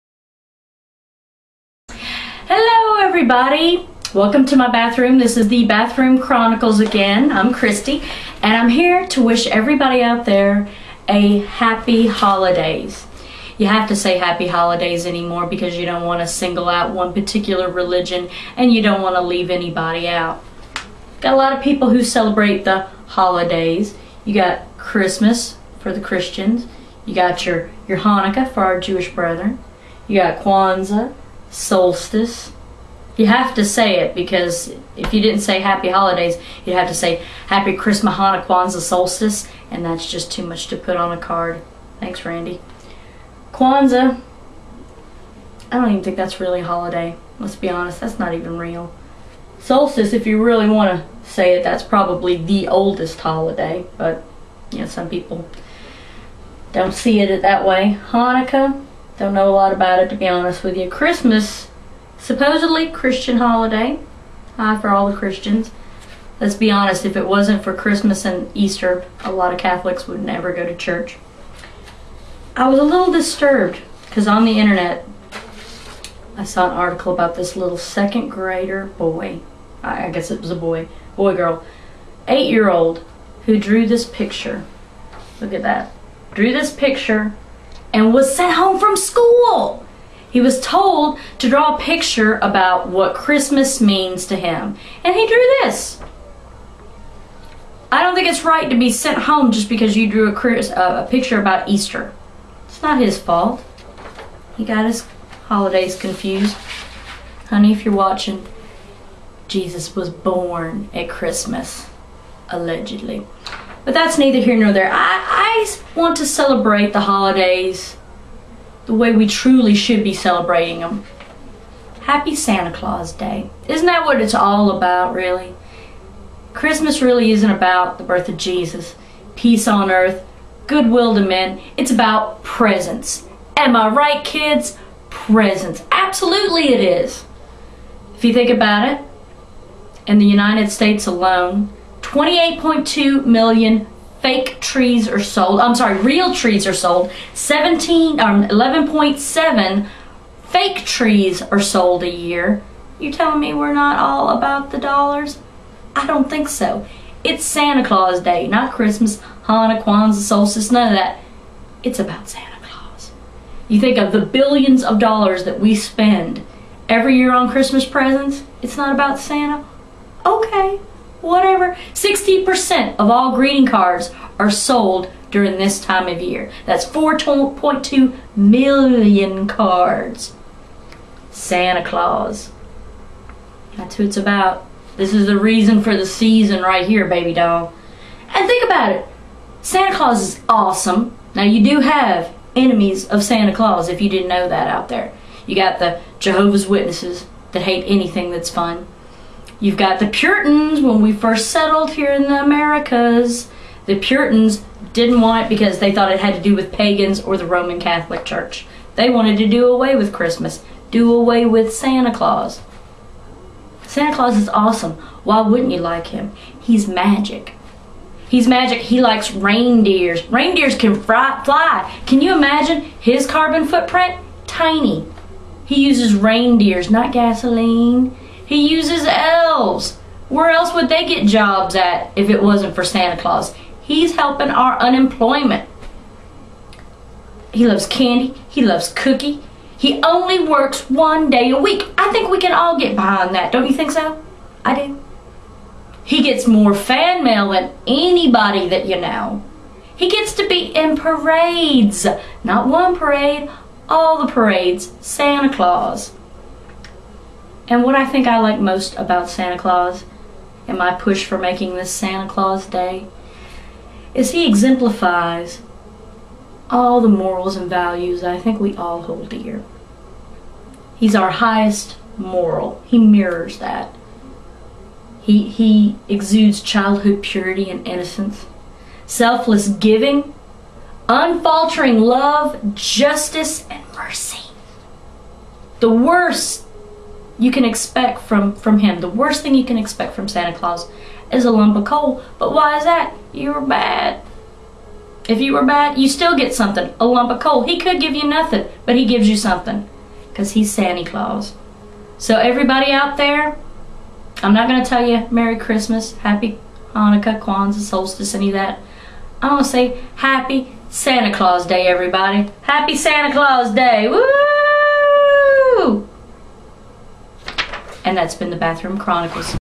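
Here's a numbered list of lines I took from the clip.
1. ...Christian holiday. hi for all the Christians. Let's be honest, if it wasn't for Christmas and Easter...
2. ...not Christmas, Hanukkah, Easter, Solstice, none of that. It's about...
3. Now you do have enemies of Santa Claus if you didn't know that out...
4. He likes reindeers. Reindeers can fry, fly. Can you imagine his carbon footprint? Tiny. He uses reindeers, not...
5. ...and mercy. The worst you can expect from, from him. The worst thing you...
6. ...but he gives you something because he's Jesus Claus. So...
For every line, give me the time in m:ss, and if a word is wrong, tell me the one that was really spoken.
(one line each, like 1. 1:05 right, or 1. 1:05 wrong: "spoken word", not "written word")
1. 1:02 right
2. 2:38 wrong: "Kwanzaa", not "Easter"
3. 3:11 right
4. 3:38 right
5. 4:43 right
6. 4:58 wrong: "Santa", not "Jesus".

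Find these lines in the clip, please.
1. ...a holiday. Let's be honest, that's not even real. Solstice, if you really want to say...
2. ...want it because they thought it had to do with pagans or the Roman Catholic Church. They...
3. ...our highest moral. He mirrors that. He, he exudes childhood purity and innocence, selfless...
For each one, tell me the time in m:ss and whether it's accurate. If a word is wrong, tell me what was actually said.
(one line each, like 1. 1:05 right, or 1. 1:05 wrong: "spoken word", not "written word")
1. 0:46 right
2. 3:25 right
3. 4:31 right.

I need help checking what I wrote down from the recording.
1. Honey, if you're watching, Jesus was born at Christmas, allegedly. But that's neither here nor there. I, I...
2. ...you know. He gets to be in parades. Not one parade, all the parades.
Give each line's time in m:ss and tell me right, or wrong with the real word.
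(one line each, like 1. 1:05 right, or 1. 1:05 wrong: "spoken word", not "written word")
1. 1:47 right
2. 4:08 right.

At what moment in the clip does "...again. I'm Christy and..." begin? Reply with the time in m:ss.
0:06.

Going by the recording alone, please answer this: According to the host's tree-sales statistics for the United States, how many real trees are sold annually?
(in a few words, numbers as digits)
28.2 million.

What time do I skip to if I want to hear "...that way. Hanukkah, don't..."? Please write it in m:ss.
0:57.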